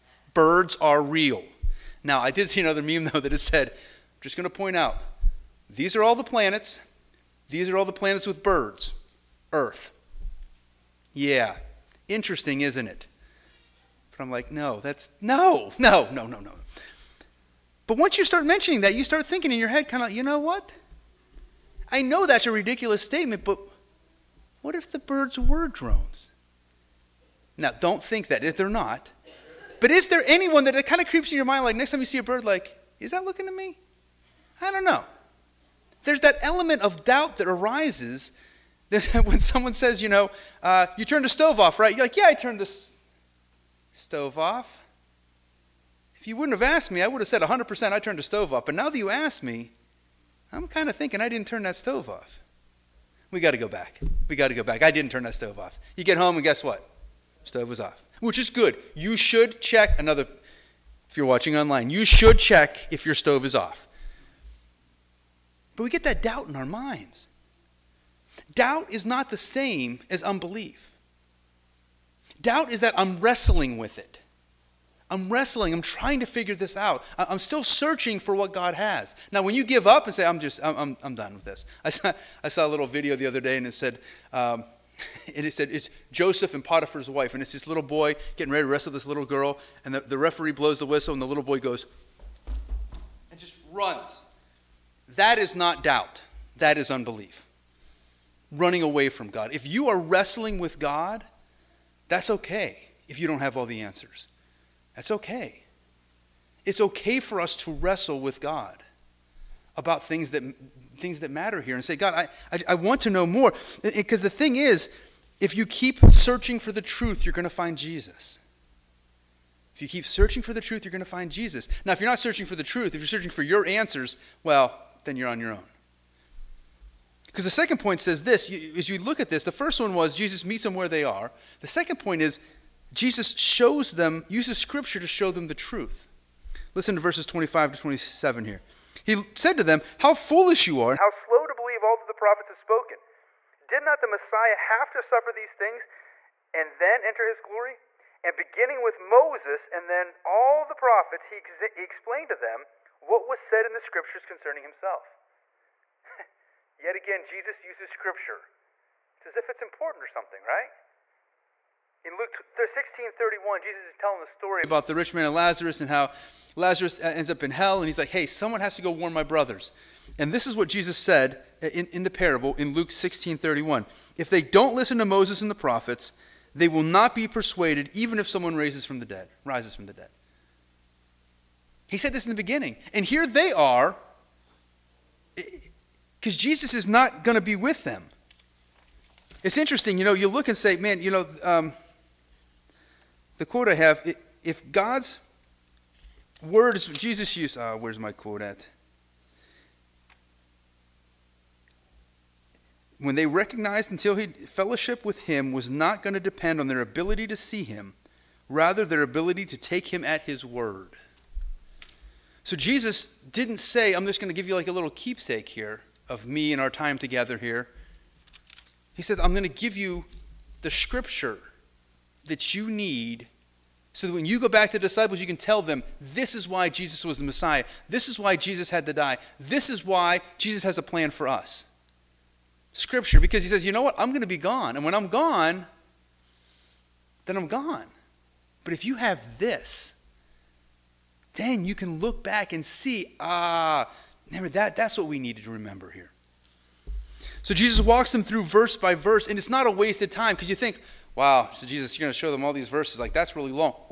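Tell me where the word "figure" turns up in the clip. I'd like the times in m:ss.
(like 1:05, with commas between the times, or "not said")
1:16.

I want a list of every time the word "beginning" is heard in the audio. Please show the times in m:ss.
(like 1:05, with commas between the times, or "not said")
2:28, 3:02.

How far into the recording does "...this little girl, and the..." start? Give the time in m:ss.
1:28.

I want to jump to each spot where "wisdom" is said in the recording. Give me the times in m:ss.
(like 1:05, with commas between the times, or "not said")
not said.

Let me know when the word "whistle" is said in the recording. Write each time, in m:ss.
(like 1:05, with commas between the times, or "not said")
1:30.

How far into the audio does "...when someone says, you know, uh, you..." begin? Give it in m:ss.
0:39.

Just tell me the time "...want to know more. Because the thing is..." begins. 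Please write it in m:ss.
1:52.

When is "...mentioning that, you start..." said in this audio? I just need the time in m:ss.
0:18.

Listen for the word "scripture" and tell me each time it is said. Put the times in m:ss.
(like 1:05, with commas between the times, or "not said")
2:14, 2:33, 2:37, 3:40, 3:52.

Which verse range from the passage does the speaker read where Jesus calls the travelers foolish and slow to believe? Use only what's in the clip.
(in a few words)
25 to 27.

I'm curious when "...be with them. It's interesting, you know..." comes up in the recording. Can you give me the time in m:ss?
3:07.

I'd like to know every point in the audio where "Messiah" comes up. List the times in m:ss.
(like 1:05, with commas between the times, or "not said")
2:24, 3:47.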